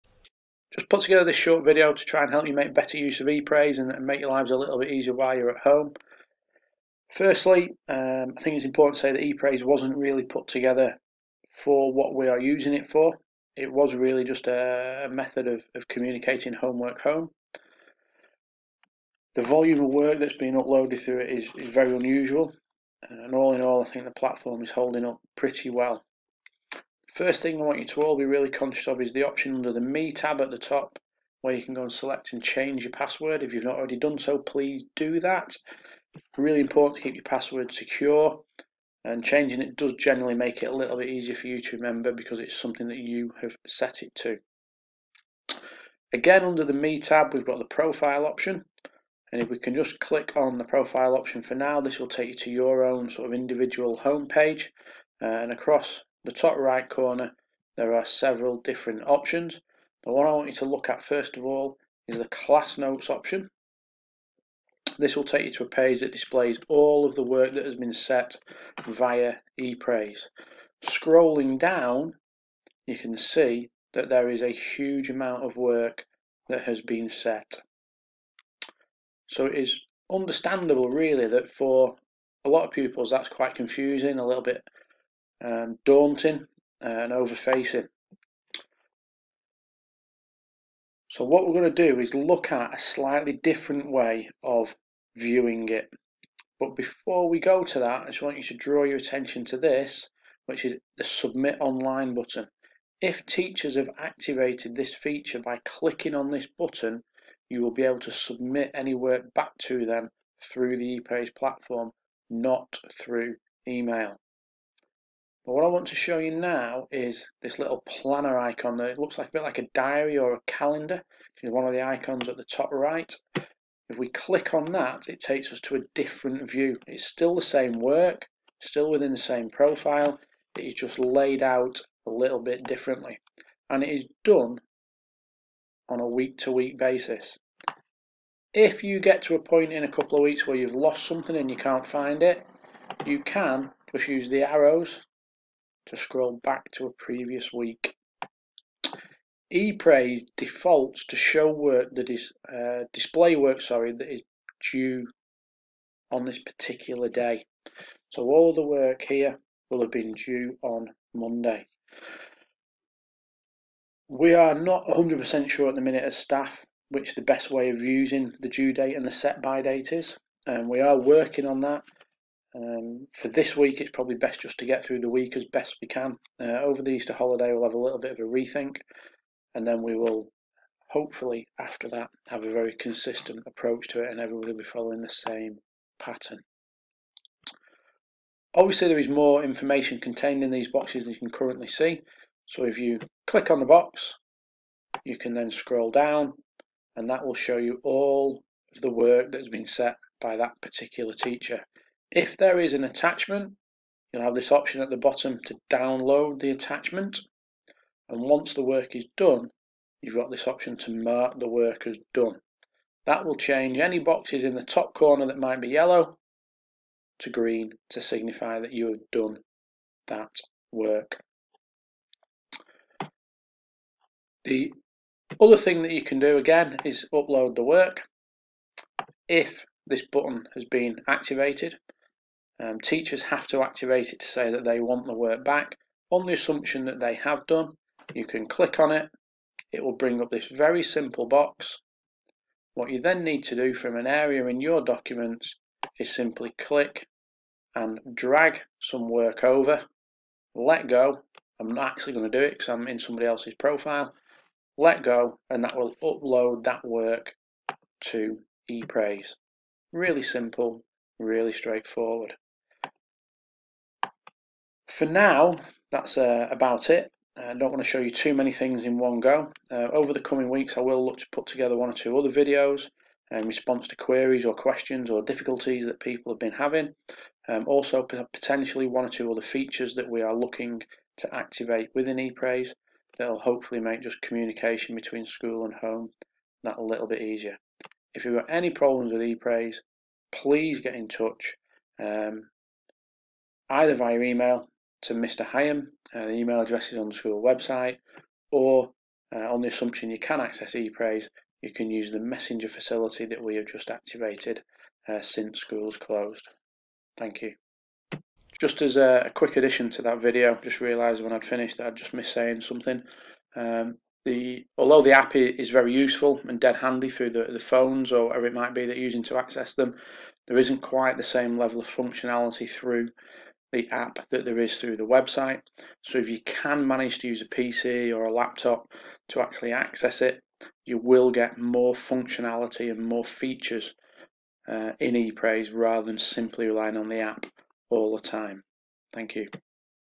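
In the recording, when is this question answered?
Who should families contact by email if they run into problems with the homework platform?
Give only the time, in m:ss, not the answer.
4:55.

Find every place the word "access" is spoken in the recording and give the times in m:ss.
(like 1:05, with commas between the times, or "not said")
5:00, 5:19, 5:29.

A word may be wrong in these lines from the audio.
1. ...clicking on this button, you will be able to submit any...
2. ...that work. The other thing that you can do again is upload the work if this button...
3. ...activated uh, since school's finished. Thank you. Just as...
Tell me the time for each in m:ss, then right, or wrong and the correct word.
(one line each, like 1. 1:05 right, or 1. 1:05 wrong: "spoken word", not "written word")
1. 1:45 right
2. 3:40 right
3. 5:03 wrong: "closed", not "finished".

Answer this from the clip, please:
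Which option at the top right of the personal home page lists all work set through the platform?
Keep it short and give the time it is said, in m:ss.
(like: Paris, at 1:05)
class notes, at 1:02.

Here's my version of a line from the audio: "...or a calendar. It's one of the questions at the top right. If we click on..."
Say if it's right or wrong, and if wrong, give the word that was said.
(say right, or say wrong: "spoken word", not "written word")
wrong: "icons", not "questions".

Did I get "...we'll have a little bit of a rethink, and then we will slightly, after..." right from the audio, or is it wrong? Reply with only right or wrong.
wrong.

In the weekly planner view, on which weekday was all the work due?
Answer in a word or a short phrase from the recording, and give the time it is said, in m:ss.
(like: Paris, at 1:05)
Monday, at 2:41.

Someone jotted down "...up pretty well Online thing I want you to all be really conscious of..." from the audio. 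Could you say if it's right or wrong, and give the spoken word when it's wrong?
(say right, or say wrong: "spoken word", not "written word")
wrong: "First", not "Online".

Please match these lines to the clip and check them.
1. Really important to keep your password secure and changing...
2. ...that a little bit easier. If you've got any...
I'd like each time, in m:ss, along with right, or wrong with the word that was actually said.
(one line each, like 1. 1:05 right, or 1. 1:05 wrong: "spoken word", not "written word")
1. 0:36 right
2. 4:46 right.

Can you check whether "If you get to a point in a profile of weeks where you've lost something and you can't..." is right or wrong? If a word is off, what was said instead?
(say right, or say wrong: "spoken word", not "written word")
wrong: "couple", not "profile".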